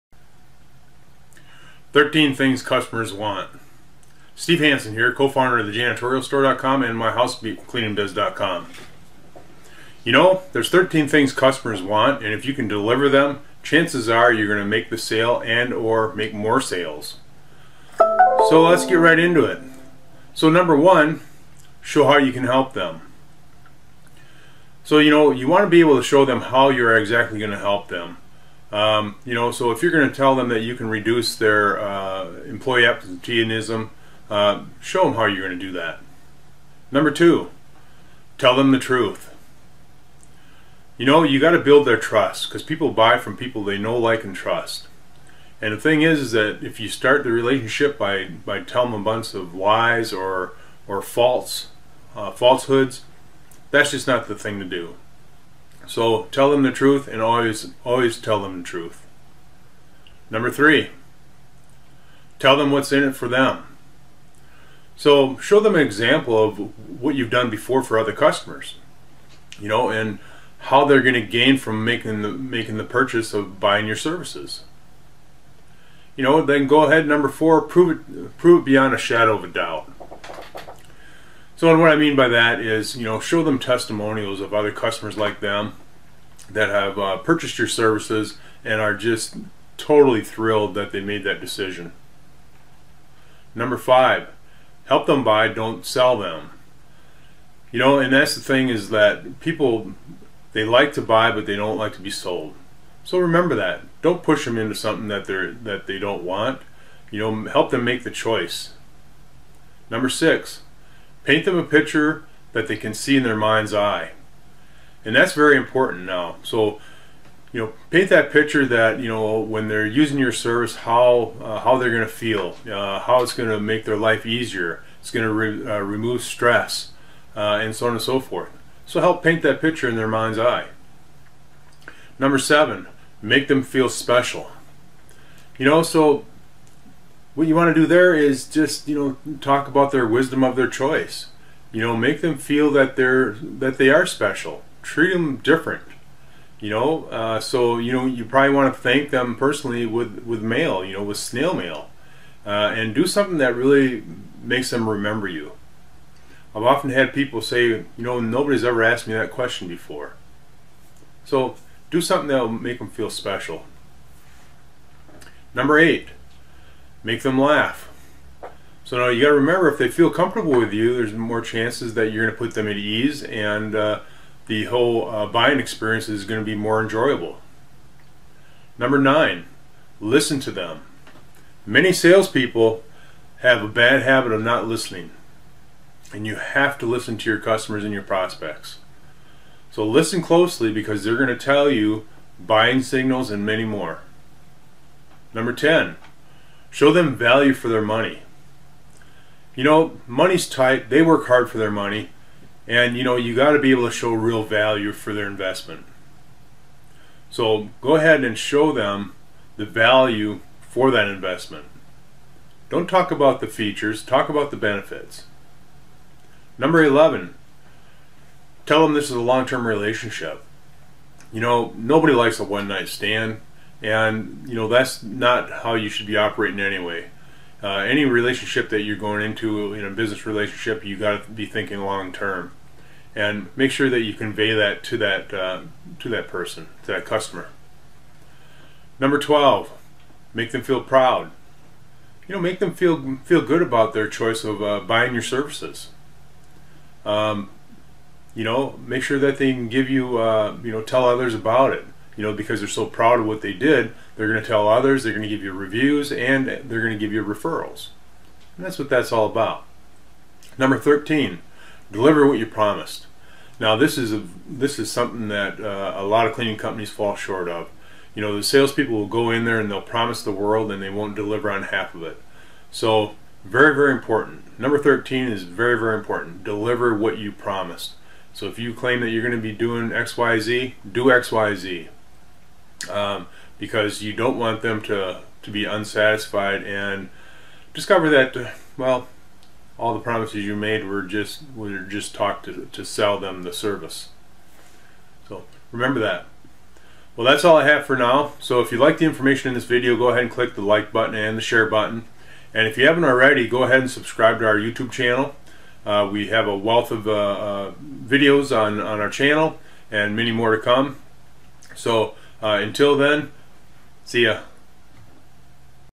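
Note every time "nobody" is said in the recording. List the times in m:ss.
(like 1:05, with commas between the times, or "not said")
2:38, 3:41.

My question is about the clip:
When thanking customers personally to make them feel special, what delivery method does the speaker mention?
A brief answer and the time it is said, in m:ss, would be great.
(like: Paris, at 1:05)
Snail mail, at 2:31.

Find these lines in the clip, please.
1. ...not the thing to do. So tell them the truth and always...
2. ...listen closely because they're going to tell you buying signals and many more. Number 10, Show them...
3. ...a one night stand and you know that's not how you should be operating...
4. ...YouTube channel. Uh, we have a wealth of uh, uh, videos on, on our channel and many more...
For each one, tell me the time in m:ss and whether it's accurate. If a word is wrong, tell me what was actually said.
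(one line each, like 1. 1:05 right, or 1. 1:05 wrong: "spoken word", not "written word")
1. 0:54 right
2. 3:09 right
3. 3:42 right
4. 5:04 right.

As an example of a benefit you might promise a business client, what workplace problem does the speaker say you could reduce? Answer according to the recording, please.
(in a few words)
Employee absenteeism.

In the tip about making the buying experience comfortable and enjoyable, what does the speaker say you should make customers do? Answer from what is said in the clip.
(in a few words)
Laugh.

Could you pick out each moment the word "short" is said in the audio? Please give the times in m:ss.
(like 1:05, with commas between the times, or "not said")
4:27.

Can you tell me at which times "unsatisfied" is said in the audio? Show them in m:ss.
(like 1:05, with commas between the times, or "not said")
4:45.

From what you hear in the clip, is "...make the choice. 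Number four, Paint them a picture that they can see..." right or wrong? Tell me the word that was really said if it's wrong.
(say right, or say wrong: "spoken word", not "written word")
wrong: "six", not "four".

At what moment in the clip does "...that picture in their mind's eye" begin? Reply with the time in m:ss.
2:09.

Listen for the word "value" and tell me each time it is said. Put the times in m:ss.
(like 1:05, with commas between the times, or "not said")
3:17, 3:24, 3:29.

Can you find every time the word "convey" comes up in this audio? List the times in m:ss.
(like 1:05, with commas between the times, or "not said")
3:54.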